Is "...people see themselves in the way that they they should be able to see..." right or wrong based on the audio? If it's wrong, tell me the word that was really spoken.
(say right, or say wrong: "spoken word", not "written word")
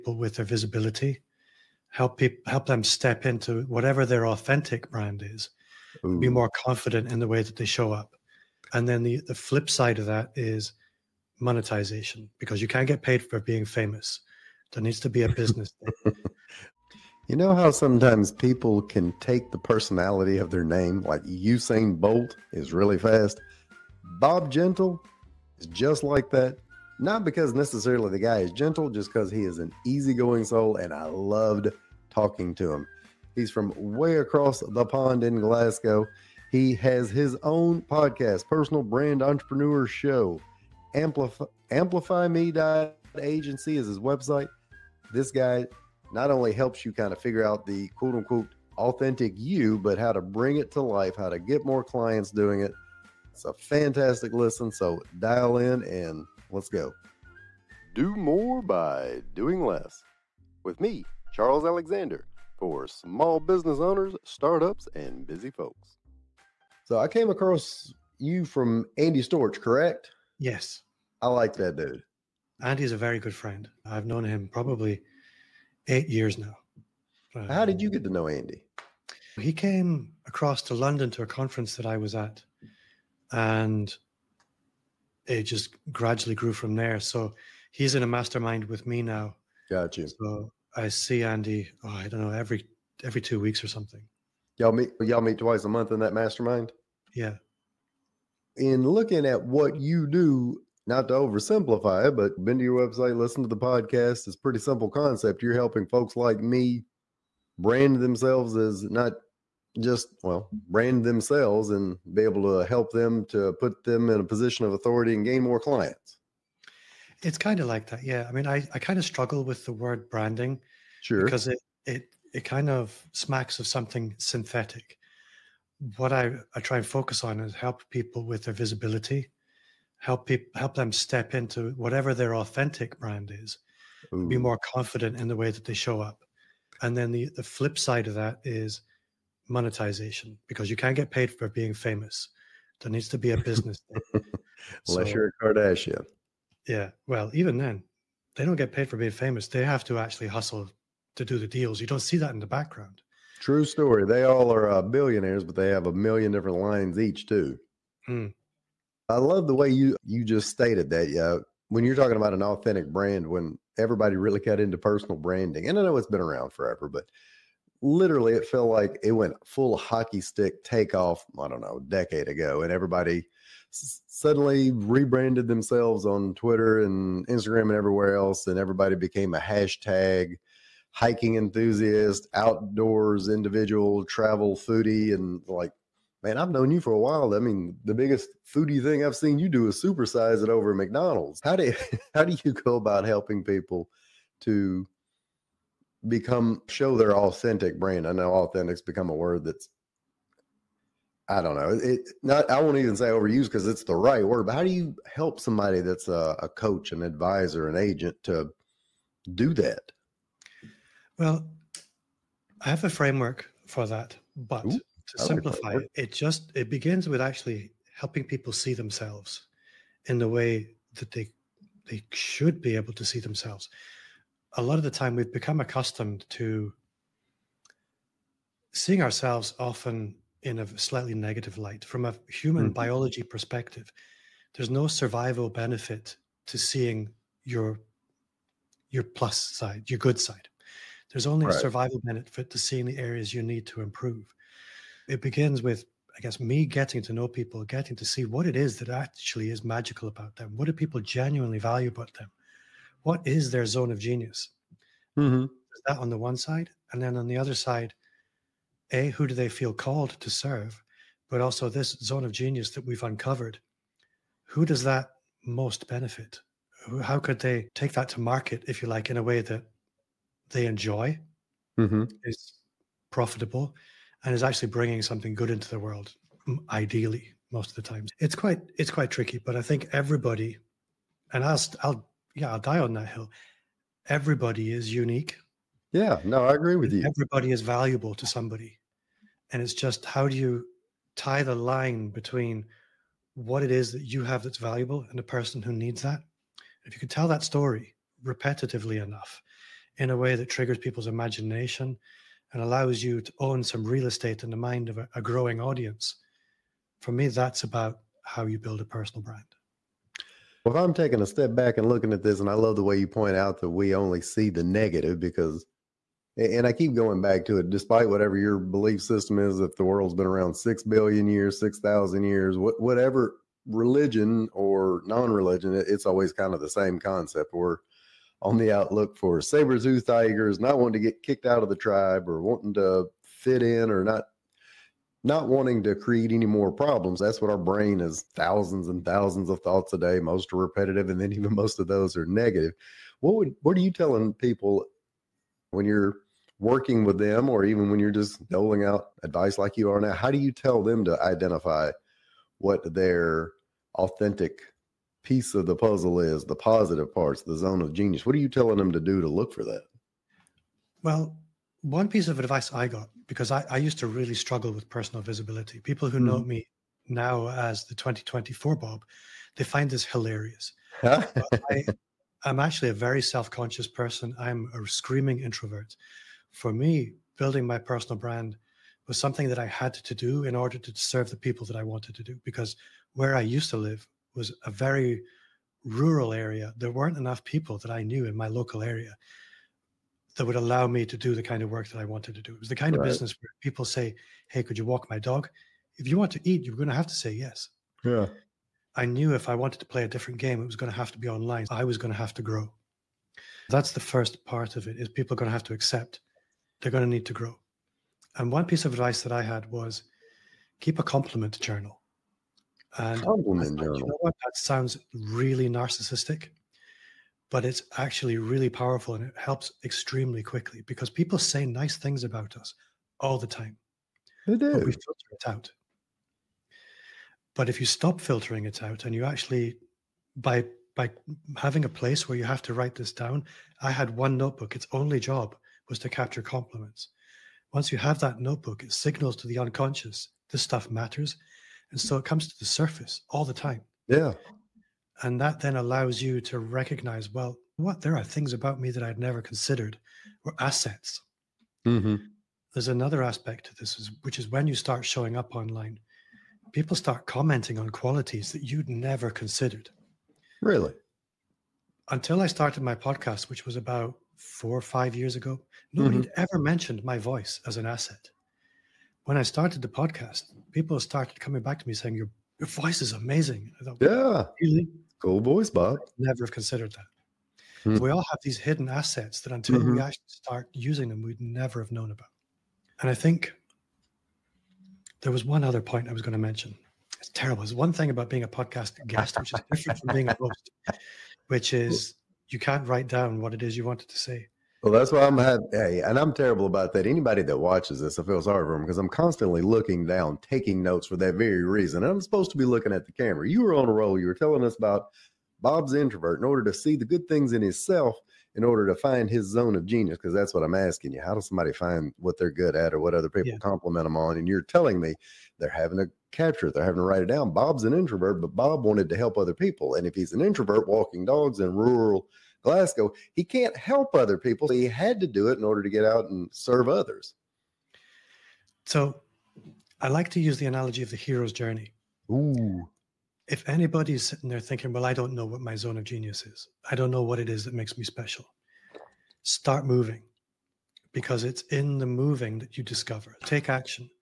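right.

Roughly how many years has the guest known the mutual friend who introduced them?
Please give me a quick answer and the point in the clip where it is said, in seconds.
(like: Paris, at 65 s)
8, at 75 s.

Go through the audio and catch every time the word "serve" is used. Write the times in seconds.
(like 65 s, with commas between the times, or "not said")
260 s, 380 s, 526 s.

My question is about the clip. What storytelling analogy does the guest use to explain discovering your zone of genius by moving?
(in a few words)
The hero's journey.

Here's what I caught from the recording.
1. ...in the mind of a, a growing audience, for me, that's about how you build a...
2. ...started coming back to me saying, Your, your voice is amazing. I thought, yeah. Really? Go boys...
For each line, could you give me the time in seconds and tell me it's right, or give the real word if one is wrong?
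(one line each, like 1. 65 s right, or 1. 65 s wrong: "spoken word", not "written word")
1. 304 s right
2. 470 s right.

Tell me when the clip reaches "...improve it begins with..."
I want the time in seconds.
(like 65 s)
243 s.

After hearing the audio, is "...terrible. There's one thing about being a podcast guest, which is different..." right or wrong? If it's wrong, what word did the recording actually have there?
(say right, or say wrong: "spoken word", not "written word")
right.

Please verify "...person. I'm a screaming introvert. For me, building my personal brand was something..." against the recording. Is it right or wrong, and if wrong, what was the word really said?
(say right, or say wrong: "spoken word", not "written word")
right.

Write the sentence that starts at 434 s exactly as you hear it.
Its only job was to capture compliments.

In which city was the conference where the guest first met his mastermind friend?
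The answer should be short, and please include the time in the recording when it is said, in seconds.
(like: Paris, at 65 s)
London, at 80 s.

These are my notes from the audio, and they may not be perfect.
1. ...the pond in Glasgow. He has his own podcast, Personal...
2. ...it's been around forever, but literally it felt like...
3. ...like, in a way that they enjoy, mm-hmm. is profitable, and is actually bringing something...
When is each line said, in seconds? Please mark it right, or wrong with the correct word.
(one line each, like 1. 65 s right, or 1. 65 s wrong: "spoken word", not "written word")
1. 34 s right
2. 165 s right
3. 268 s right.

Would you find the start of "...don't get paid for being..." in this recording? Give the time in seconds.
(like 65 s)
148 s.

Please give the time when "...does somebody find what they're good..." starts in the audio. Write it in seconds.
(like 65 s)
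511 s.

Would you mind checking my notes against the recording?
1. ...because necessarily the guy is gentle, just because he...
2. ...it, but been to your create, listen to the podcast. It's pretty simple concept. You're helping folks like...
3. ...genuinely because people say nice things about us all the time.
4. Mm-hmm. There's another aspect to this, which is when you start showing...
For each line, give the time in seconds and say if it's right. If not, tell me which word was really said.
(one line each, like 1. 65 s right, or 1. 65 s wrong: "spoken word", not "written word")
1. 27 s right
2. 102 s wrong: "website", not "create"
3. 420 s wrong: "quickly", not "genuinely"
4. 451 s right.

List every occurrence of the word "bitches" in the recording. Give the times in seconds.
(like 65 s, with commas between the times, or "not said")
not said.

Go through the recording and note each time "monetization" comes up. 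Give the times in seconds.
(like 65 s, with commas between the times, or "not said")
11 s, 139 s.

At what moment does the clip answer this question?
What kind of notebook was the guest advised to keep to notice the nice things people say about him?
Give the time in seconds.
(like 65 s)
411 s.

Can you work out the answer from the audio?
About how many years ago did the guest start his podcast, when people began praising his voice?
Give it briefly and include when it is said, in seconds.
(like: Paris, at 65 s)
4 or 5, at 464 s.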